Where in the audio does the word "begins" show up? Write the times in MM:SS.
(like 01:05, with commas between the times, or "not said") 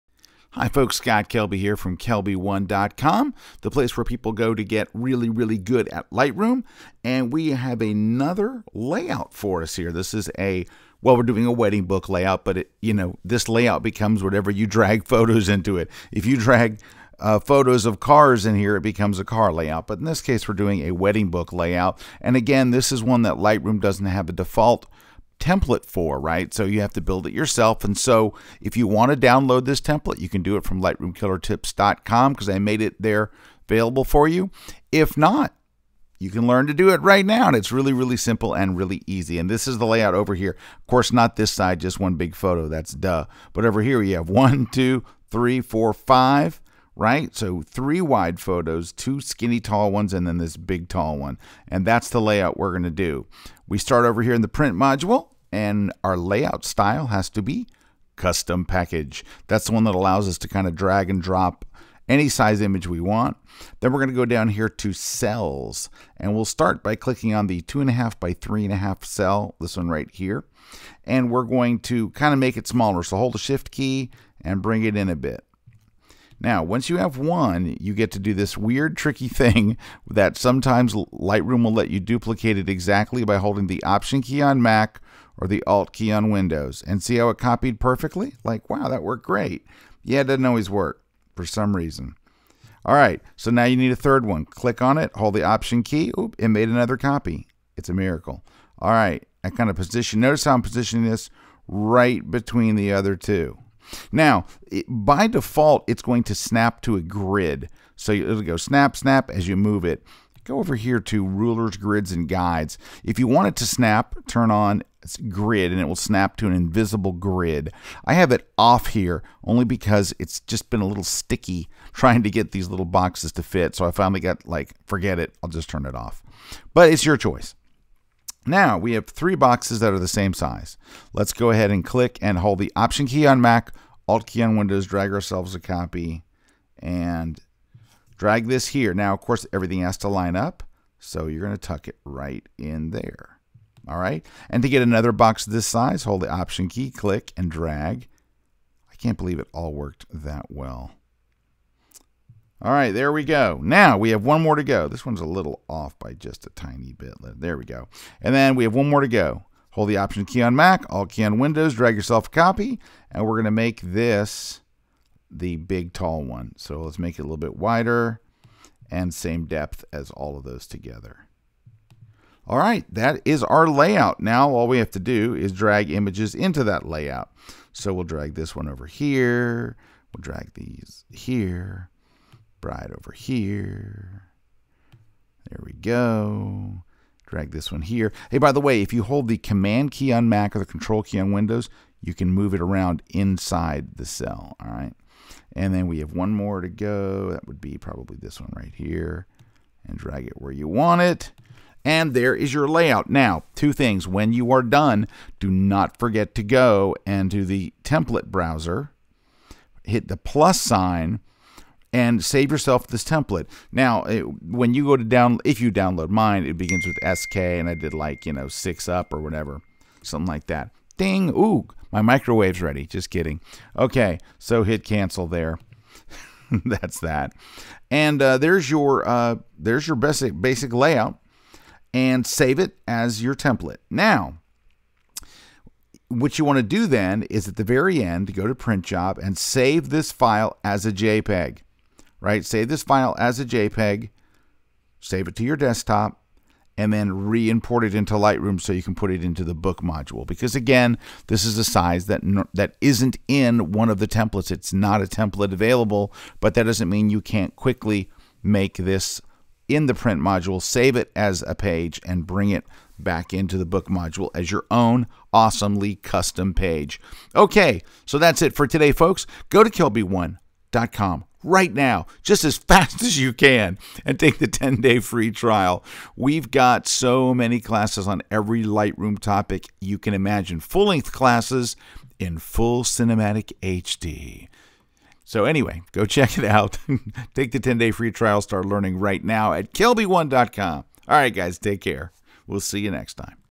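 03:36.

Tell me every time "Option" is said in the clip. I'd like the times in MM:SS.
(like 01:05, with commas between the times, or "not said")
01:23, 01:35, 02:12, 02:26, 02:39.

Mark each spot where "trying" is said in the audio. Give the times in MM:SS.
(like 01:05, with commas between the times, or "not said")
02:01.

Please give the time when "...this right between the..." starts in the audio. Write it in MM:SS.
01:41.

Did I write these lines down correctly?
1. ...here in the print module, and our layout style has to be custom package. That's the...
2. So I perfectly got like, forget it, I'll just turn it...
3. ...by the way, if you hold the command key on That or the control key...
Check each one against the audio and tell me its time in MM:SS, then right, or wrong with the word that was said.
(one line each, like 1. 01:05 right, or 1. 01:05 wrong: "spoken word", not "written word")
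1. 00:54 right
2. 02:03 wrong: "finally", not "perfectly"
3. 03:08 wrong: "Mac", not "That".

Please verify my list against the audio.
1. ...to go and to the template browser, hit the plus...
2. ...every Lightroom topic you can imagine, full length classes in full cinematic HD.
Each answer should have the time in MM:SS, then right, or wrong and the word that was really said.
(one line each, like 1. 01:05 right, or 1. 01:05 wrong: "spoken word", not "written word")
1. 03:26 right
2. 04:38 right.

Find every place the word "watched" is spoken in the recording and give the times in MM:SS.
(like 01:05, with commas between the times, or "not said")
not said.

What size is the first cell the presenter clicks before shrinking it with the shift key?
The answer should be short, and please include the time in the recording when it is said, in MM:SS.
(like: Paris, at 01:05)
2.5 by 3.5, at 01:07.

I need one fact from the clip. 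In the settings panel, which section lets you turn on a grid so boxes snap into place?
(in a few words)
Rulers, grids, and guides.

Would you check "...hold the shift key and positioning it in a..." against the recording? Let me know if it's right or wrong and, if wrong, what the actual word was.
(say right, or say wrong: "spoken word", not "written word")
wrong: "bring", not "positioning".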